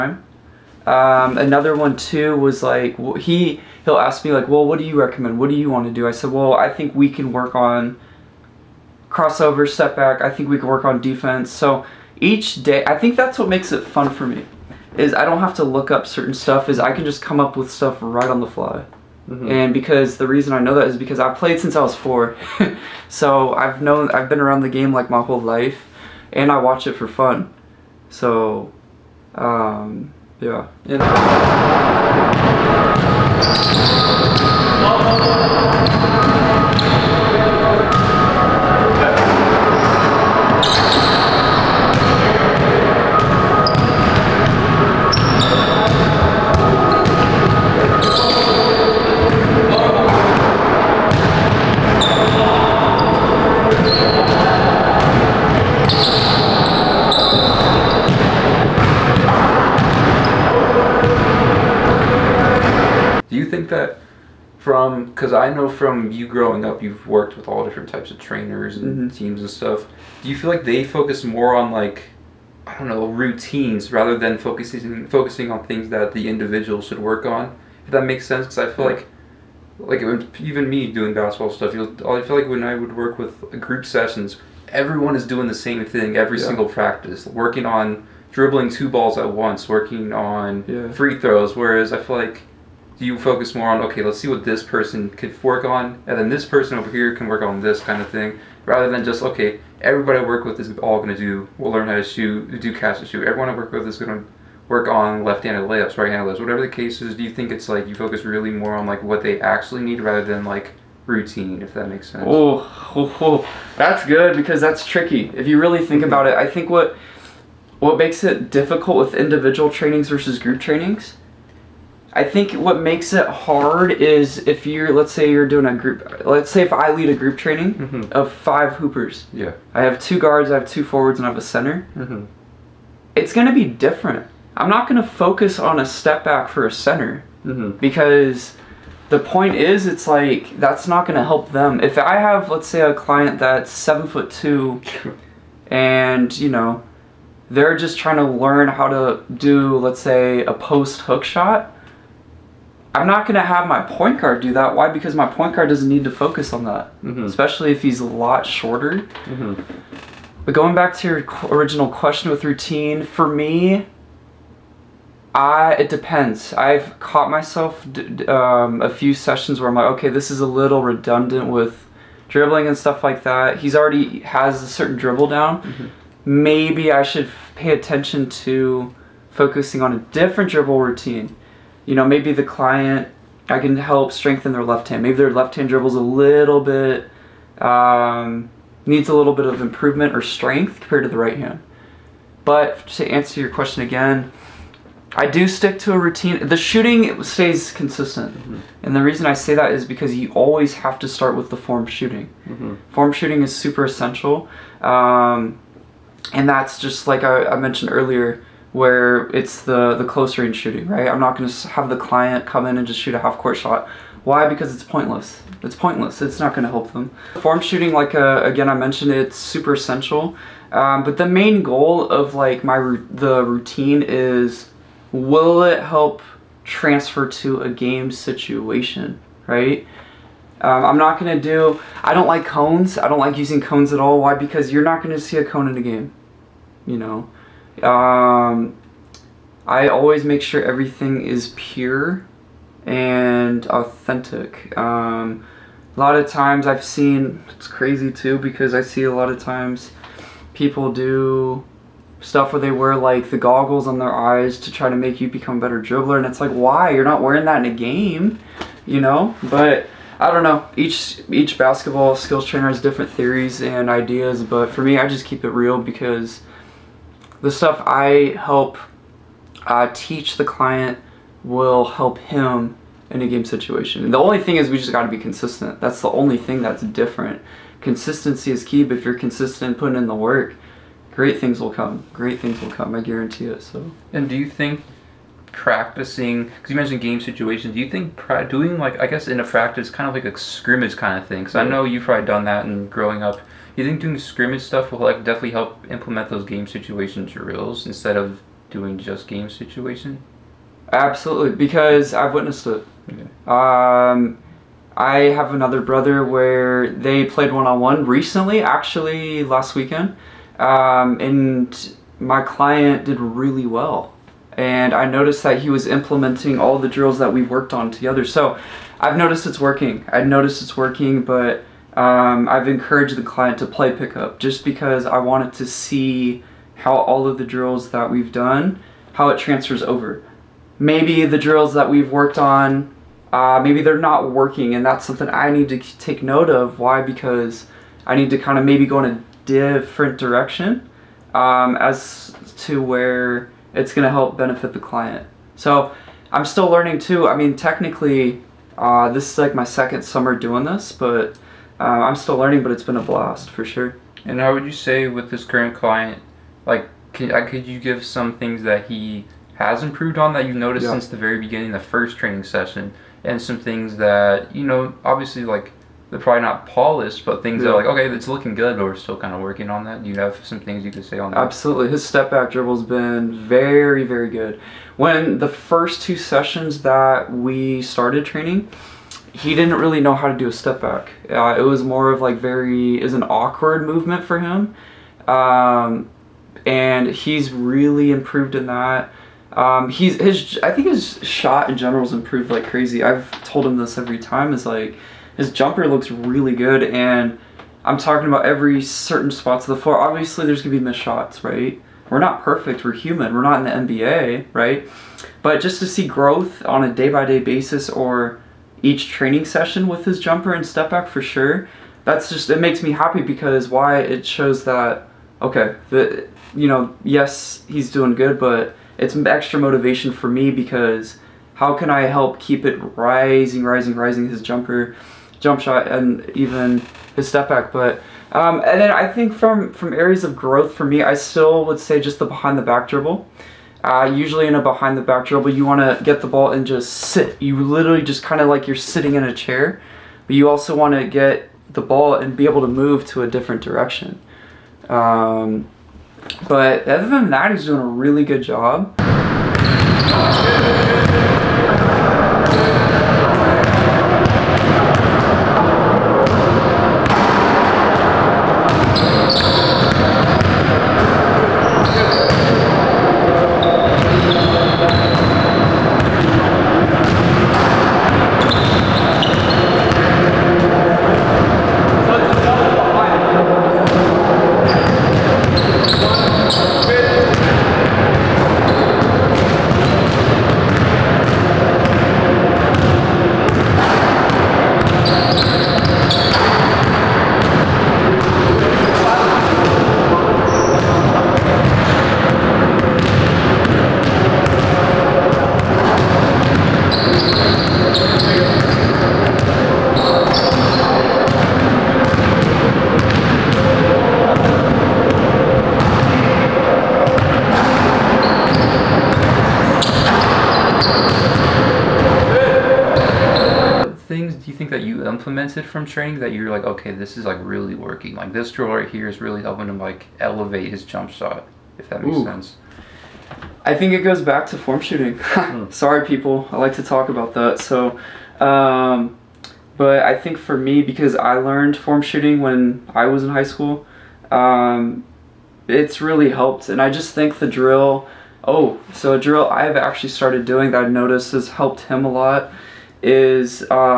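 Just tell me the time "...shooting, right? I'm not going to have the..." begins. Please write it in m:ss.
3:30.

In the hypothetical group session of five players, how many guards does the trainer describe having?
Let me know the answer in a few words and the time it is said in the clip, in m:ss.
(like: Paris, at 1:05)
2, at 2:09.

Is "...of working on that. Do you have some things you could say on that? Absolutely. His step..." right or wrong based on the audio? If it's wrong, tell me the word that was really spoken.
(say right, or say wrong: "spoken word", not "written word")
right.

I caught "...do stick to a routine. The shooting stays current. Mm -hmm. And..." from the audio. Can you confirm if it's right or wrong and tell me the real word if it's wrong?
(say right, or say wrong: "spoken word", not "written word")
wrong: "consistent", not "current".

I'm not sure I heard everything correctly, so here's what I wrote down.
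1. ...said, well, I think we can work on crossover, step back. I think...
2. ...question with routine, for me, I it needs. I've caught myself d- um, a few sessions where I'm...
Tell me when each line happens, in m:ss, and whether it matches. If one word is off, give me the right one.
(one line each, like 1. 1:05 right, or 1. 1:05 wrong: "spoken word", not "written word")
1. 0:06 right
2. 2:41 wrong: "depends", not "needs".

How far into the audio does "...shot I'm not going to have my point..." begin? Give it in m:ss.
2:31.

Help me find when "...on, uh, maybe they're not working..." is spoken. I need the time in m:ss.
5:32.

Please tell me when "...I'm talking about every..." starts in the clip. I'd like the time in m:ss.
6:37.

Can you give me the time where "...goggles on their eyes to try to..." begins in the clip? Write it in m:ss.
4:13.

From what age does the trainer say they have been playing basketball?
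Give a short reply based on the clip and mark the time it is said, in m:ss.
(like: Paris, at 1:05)
4, at 0:21.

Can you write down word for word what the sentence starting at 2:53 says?
He's already has a certain dribble down.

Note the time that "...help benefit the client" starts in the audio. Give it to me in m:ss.
5:44.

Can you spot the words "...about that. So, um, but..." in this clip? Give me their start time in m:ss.
8:47.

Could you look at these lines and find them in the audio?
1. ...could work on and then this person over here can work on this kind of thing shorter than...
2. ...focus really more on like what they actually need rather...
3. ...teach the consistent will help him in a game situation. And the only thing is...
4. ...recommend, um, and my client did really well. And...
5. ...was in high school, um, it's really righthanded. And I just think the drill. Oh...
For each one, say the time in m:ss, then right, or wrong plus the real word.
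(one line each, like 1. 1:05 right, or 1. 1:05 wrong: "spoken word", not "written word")
1. 1:35 wrong: "rather", not "shorter"
2. 1:47 right
3. 4:29 wrong: "client", not "consistent"
4. 5:09 wrong: "weekend", not "recommend"
5. 8:53 wrong: "helped", not "righthanded".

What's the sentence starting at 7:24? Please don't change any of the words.
Um, but other than that, he's doing a really good job.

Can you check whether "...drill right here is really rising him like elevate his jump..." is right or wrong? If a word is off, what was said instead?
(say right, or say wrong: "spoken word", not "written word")
wrong: "helping", not "rising".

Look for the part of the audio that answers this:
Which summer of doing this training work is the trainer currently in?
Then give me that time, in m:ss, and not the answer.
5:49.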